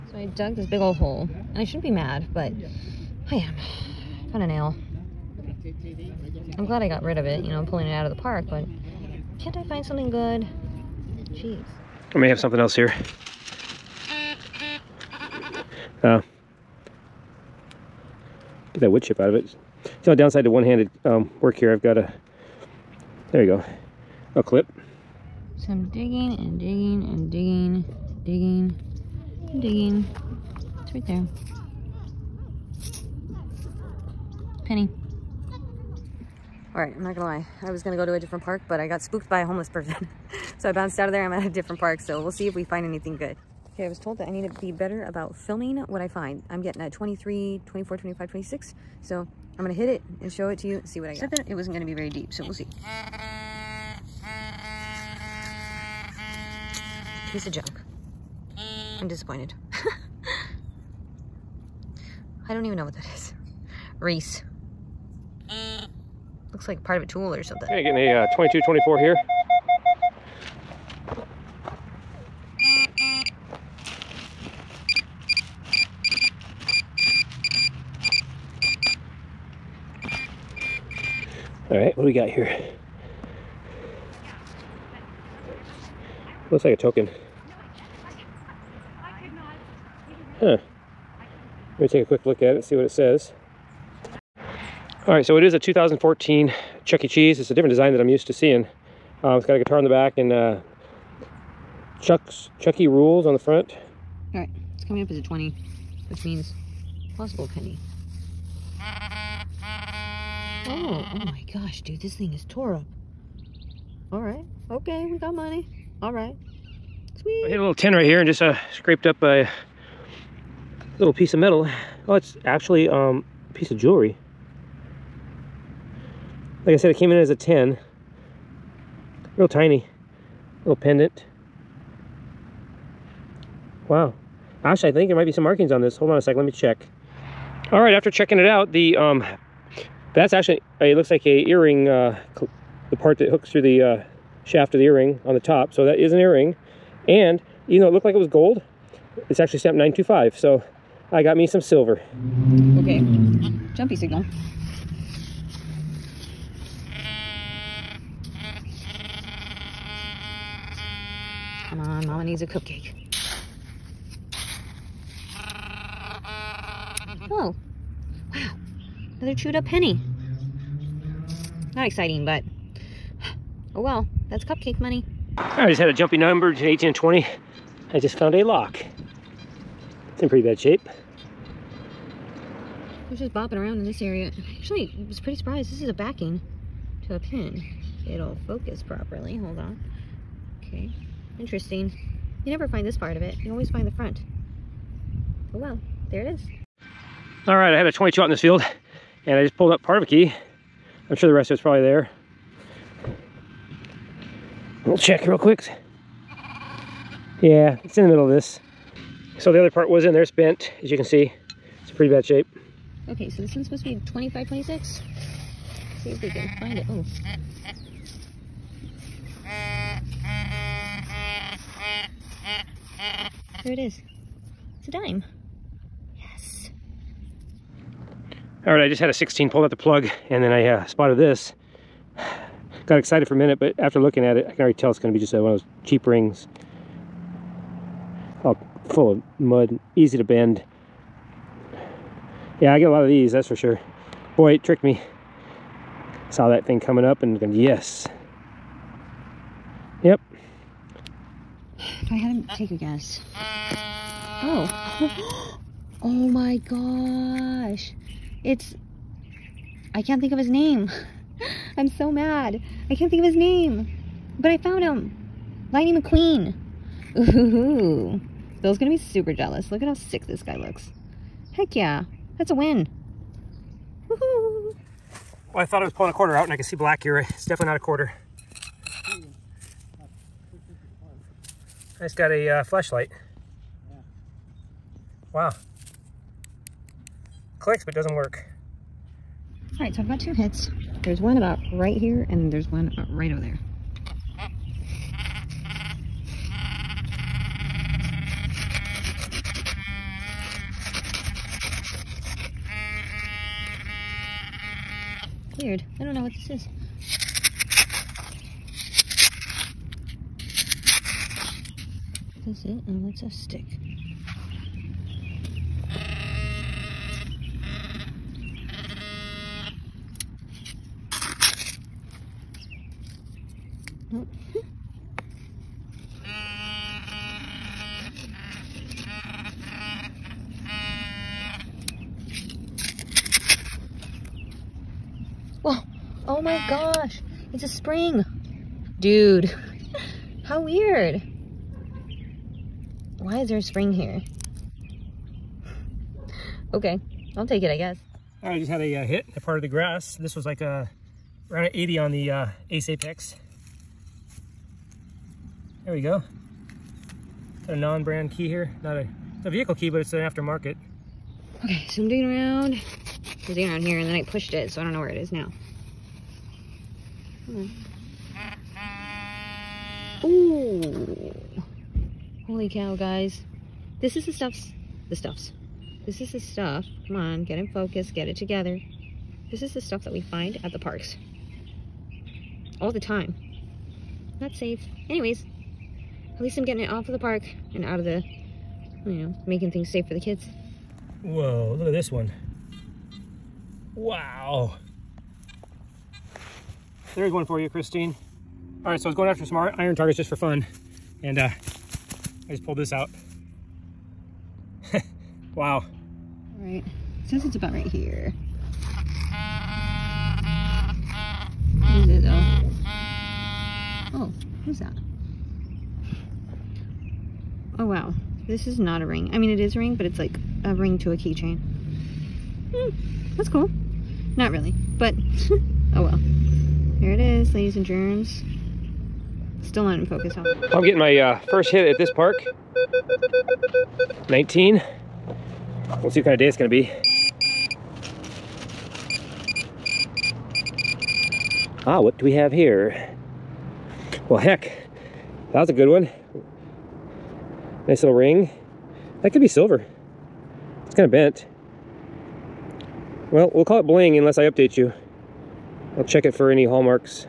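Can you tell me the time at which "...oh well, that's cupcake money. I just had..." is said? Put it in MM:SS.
02:53.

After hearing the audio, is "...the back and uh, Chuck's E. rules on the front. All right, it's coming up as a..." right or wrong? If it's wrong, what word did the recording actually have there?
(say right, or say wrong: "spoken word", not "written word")
right.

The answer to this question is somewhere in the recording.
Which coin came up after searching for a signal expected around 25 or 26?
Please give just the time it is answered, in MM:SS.
03:44.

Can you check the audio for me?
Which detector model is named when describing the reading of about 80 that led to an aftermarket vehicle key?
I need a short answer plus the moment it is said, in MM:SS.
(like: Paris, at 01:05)
Ace Apex, at 05:52.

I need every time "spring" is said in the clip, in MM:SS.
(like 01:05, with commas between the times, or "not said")
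05:37, 05:43.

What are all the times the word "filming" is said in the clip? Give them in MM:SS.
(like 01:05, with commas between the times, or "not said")
00:45.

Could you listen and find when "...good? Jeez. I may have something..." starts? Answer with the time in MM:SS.
00:10.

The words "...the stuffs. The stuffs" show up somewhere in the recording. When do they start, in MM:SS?
06:14.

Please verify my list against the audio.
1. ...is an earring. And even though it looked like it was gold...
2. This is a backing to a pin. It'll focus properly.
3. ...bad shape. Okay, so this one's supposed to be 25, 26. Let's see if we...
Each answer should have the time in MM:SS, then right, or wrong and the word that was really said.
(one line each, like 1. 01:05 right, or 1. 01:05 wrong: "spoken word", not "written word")
1. 02:25 right
2. 03:05 right
3. 03:32 right.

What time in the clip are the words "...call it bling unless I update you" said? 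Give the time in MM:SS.
07:33.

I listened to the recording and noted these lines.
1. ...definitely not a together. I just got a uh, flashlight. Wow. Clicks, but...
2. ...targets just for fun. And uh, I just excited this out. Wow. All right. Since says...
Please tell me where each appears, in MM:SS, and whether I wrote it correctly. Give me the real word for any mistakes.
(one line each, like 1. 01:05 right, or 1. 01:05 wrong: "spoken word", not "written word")
1. 04:37 wrong: "quarter", not "together"
2. 06:39 wrong: "pulled", not "excited".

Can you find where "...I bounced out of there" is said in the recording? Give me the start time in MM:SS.
00:40.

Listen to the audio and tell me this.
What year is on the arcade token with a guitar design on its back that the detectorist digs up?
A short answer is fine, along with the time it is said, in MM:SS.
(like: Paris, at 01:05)
2014, at 01:35.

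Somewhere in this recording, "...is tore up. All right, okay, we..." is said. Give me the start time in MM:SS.
01:52.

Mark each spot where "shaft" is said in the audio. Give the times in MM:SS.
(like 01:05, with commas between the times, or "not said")
02:24.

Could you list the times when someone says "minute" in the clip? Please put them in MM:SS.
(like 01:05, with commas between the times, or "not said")
03:53.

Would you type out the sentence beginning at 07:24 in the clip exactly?
Well, heck, that was a good one.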